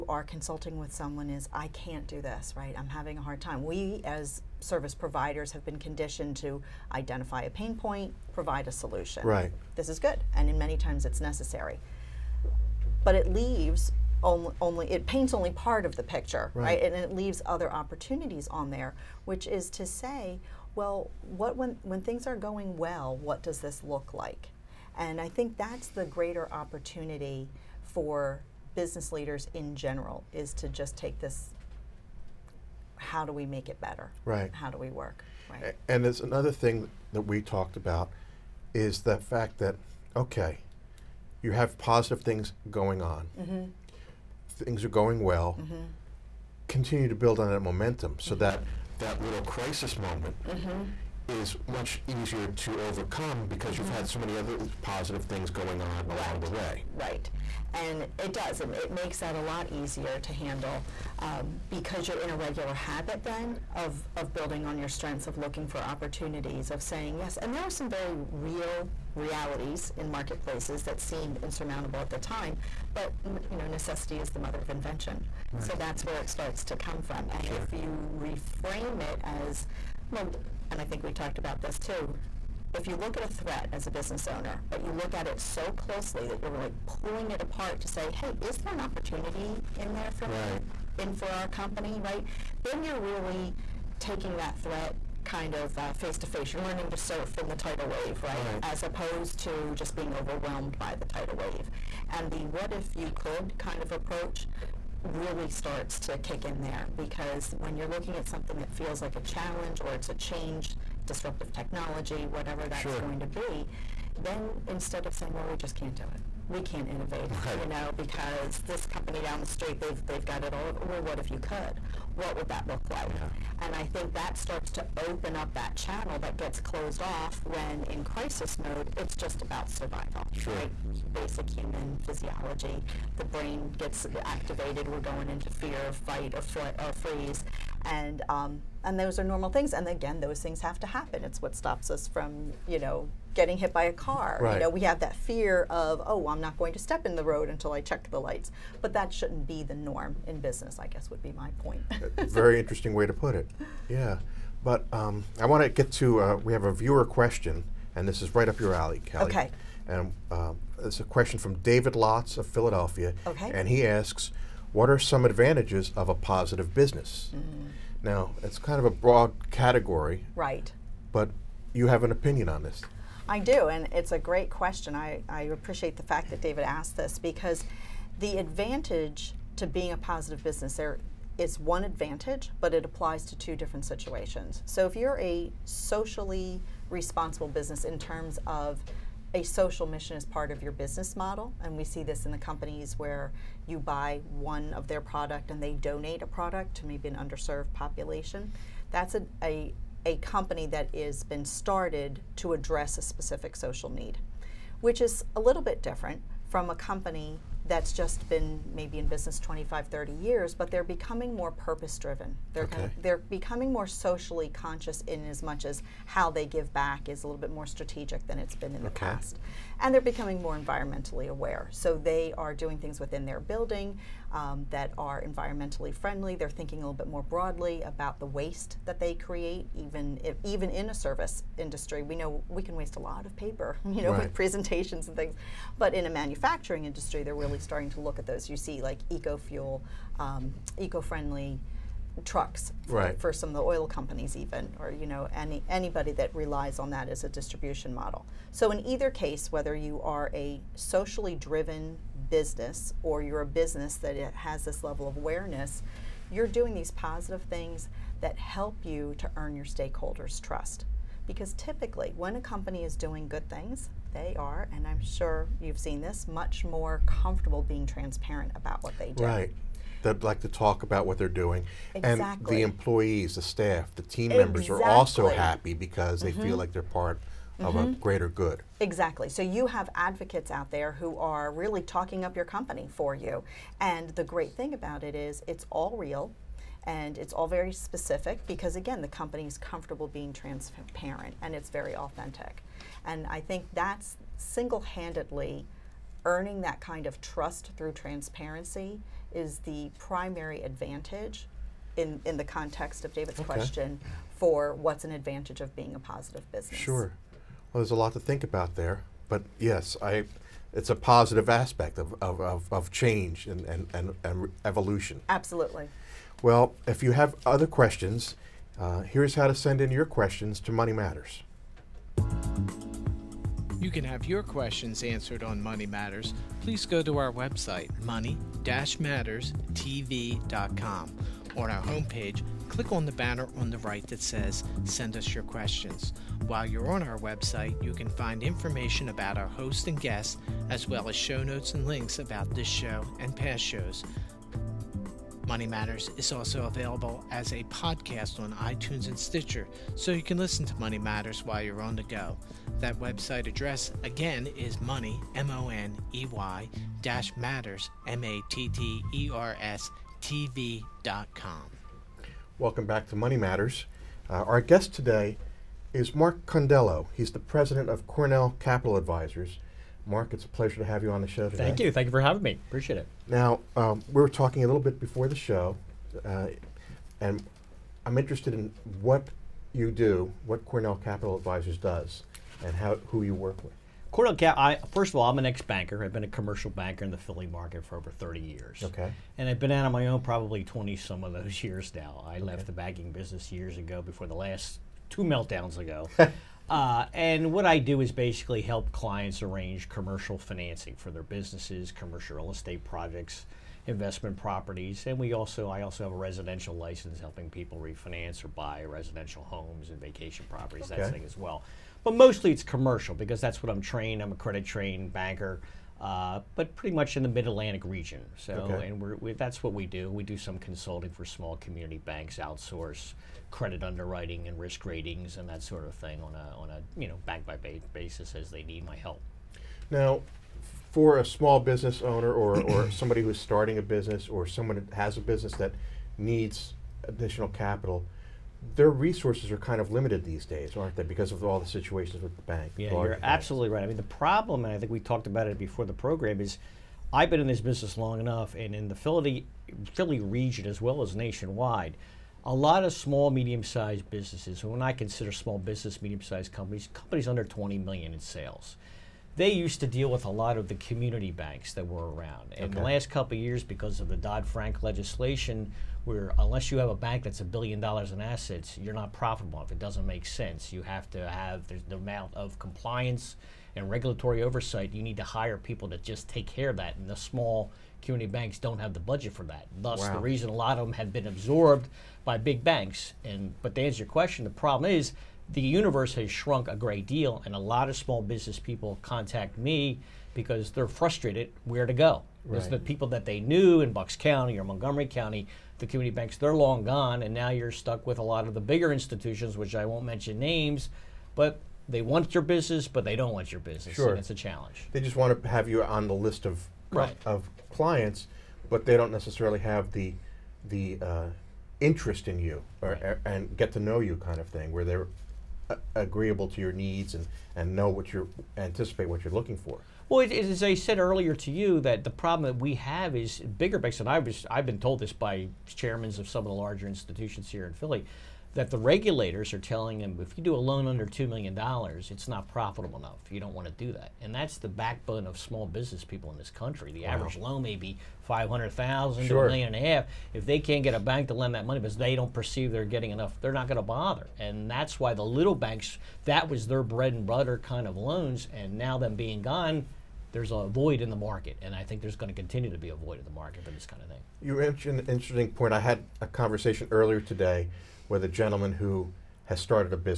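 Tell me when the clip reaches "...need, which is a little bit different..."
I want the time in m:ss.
3:23.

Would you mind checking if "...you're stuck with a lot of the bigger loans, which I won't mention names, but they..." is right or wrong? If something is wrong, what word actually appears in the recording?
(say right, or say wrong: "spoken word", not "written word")
wrong: "institutions", not "loans".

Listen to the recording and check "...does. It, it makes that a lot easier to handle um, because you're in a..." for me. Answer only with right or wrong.
right.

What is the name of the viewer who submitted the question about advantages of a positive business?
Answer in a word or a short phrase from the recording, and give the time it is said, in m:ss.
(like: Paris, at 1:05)
David Lotz, at 2:41.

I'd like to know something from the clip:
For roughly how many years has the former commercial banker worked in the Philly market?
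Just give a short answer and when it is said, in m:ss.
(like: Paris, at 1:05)
Over 30 years, at 6:27.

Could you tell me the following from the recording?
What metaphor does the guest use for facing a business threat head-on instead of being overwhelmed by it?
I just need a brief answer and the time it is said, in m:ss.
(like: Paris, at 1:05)
Learning to surf, at 1:36.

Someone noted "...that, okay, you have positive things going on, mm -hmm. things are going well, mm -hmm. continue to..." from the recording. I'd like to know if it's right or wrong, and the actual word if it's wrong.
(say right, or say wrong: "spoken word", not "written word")
right.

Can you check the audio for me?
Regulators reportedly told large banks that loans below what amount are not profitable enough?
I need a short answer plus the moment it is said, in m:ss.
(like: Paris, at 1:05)
$2 million, at 8:51.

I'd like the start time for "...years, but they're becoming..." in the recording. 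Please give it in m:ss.
3:30.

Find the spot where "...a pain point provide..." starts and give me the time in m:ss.
0:07.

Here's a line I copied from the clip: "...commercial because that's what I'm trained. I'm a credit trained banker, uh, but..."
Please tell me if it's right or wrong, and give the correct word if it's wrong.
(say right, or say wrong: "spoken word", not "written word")
right.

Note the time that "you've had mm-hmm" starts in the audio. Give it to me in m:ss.
0:53.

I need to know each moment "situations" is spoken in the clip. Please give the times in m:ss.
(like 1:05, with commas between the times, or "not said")
3:03, 7:21.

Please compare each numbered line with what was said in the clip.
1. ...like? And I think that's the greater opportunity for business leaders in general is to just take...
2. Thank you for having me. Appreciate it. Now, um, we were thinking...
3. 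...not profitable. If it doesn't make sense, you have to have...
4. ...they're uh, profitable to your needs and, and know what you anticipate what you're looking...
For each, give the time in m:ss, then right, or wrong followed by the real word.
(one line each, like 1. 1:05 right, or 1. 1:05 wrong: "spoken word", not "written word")
1. 0:24 right
2. 6:11 wrong: "talking", not "thinking"
3. 7:48 right
4. 8:34 wrong: "agreeable", not "profitable".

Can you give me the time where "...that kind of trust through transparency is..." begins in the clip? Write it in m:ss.
4:56.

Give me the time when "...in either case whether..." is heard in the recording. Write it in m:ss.
4:08.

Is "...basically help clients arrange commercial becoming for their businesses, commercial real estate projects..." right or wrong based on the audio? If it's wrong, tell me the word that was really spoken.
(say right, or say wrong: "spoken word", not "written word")
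wrong: "financing", not "becoming".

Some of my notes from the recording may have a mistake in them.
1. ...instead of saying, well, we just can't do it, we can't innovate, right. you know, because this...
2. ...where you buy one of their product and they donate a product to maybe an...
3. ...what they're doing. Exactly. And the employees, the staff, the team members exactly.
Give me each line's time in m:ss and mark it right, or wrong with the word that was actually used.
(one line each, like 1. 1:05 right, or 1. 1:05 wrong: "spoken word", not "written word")
1. 1:54 right
2. 3:12 right
3. 4:31 right.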